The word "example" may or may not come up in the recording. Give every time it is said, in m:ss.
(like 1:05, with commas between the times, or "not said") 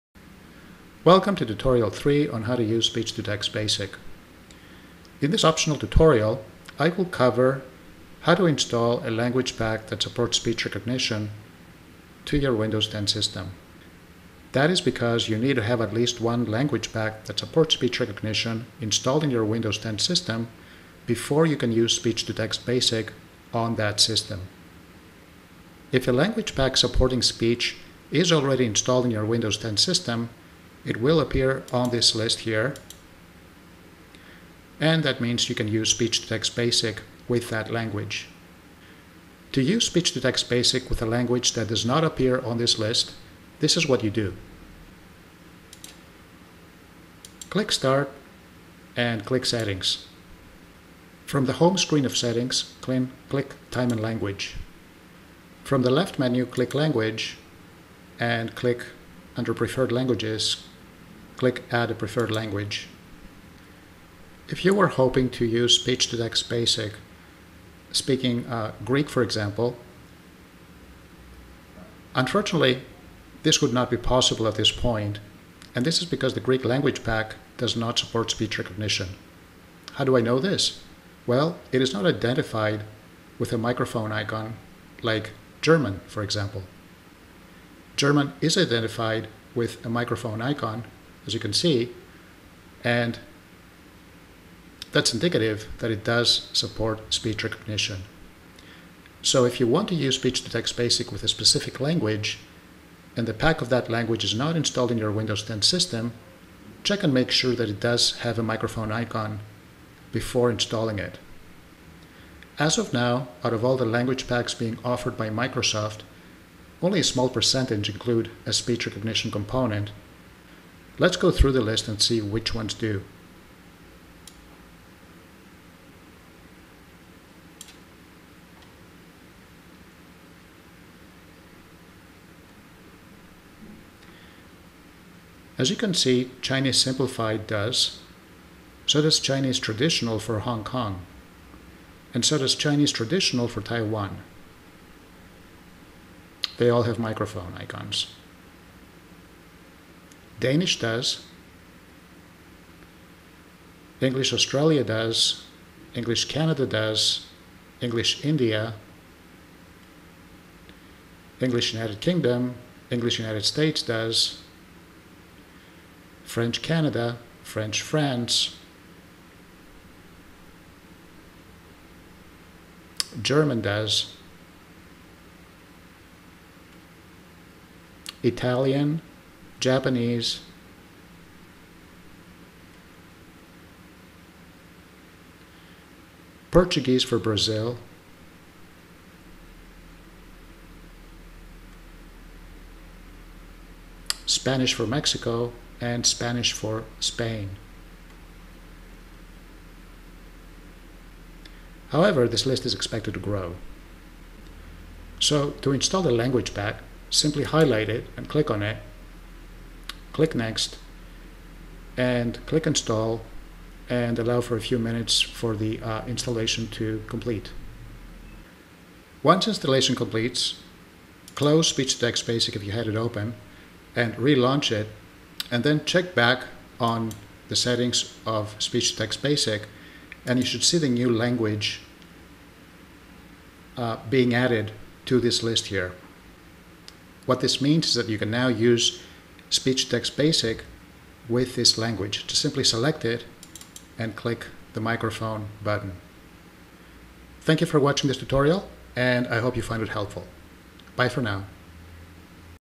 1:09, 1:26.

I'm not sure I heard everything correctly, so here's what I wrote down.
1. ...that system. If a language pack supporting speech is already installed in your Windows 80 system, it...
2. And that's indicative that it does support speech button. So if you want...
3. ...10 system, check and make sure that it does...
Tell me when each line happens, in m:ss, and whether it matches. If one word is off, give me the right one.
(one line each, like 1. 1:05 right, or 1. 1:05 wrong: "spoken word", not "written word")
1. 0:23 wrong: "10", not "80"
2. 1:32 wrong: "recognition", not "button"
3. 1:45 right.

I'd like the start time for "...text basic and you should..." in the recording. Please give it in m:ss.
3:48.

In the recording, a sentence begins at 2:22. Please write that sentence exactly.
And so does Chinese Traditional for Taiwan.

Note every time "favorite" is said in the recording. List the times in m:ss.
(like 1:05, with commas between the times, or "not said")
not said.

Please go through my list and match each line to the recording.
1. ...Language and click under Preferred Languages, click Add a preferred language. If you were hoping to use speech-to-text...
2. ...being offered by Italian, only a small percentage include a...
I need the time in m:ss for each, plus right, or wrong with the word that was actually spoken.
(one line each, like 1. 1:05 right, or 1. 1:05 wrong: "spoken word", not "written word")
1. 0:56 right
2. 1:54 wrong: "Microsoft", not "Italian".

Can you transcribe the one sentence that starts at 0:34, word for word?
And that means you can use Speech-to-Text Basic with that language.